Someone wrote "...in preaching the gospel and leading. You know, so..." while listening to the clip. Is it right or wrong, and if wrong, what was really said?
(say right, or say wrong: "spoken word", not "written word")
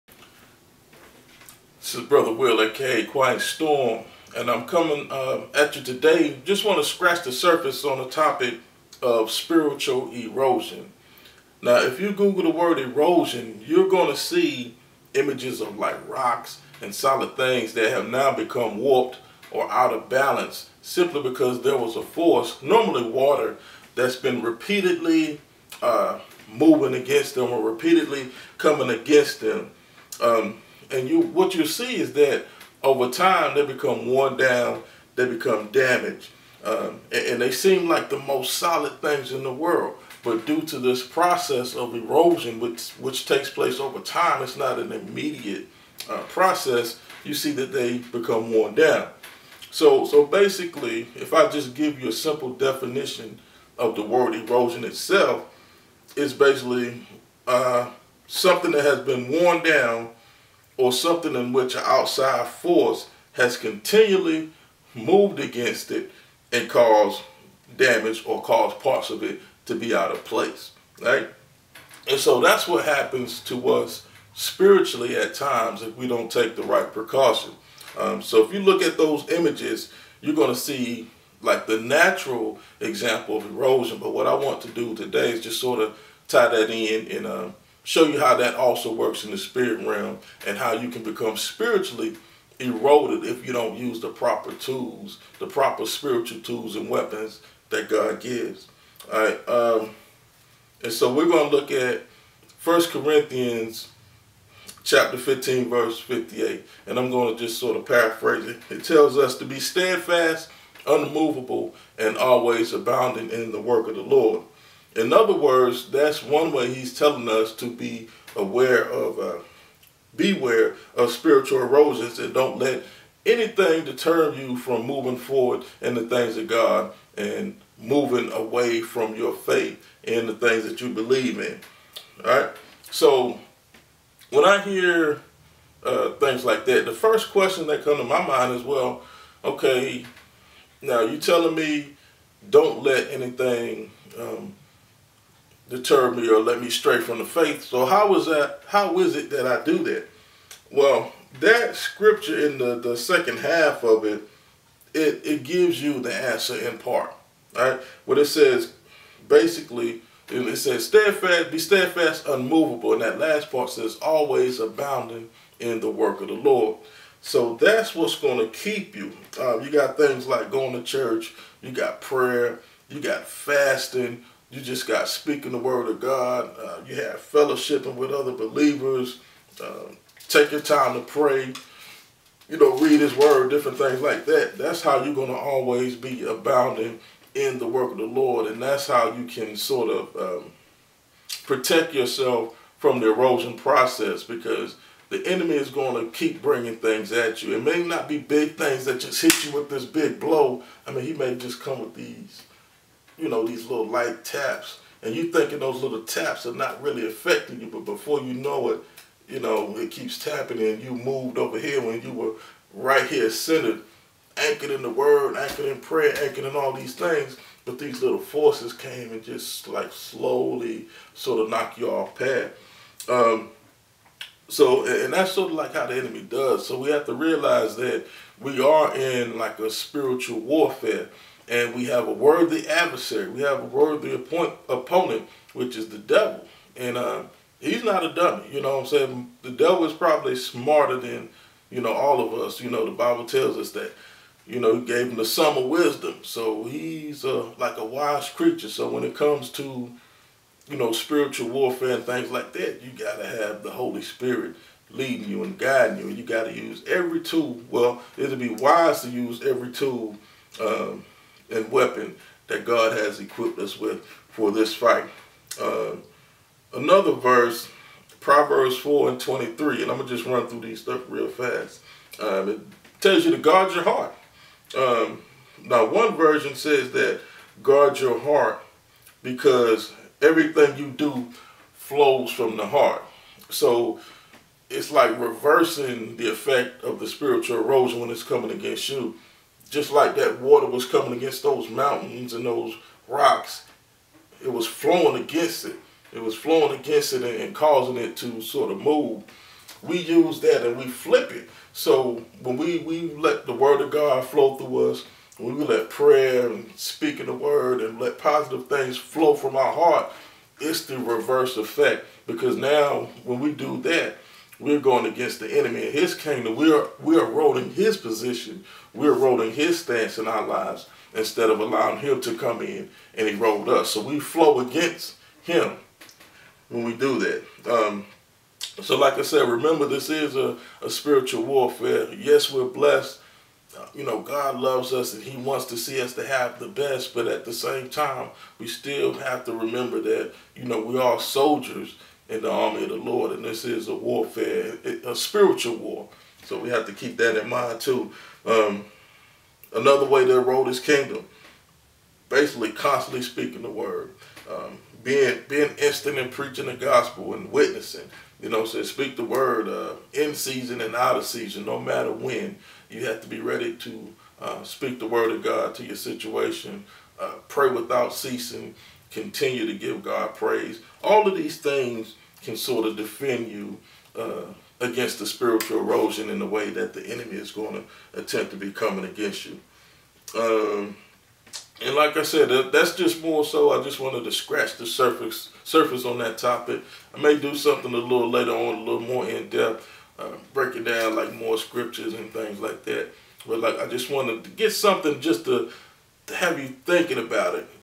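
wrong: "witnessing", not "leading".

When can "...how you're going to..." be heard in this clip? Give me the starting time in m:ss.
3:04.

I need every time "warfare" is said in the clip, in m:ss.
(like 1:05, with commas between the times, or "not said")
3:50, 4:11, 5:31, 5:43.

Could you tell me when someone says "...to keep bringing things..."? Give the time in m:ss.
3:16.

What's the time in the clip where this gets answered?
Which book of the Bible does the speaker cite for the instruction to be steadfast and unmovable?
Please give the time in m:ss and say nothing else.
1:42.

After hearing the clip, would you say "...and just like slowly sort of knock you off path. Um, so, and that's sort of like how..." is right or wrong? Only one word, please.
right.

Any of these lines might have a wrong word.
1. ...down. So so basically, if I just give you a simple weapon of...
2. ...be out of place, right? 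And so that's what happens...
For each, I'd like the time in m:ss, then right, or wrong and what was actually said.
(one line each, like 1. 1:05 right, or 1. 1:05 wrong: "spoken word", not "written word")
1. 0:48 wrong: "definition", not "weapon"
2. 1:09 right.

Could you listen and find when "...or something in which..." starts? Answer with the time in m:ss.
1:00.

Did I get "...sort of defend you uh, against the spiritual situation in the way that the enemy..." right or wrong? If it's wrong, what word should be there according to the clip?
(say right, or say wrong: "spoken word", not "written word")
wrong: "erosion", not "situation".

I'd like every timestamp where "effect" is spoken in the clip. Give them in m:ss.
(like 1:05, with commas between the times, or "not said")
4:46, 5:11.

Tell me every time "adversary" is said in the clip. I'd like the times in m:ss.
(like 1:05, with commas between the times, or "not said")
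3:52.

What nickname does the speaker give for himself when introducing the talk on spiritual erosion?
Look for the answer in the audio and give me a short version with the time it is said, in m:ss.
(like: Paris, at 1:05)
Quiet Storm, at 0:03.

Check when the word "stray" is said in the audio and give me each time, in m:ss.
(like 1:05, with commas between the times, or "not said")
2:26.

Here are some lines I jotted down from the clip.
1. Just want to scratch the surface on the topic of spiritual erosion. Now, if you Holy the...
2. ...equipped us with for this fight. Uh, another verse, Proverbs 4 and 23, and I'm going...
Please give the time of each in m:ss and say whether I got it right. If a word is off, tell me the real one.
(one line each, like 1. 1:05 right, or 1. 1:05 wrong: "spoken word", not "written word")
1. 0:06 wrong: "Google", not "Holy"
2. 4:23 right.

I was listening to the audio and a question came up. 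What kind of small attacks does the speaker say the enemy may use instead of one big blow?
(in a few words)
Little light taps.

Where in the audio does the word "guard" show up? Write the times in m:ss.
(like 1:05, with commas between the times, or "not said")
4:33, 4:37.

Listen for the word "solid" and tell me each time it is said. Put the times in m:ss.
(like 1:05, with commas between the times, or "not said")
0:16, 0:38.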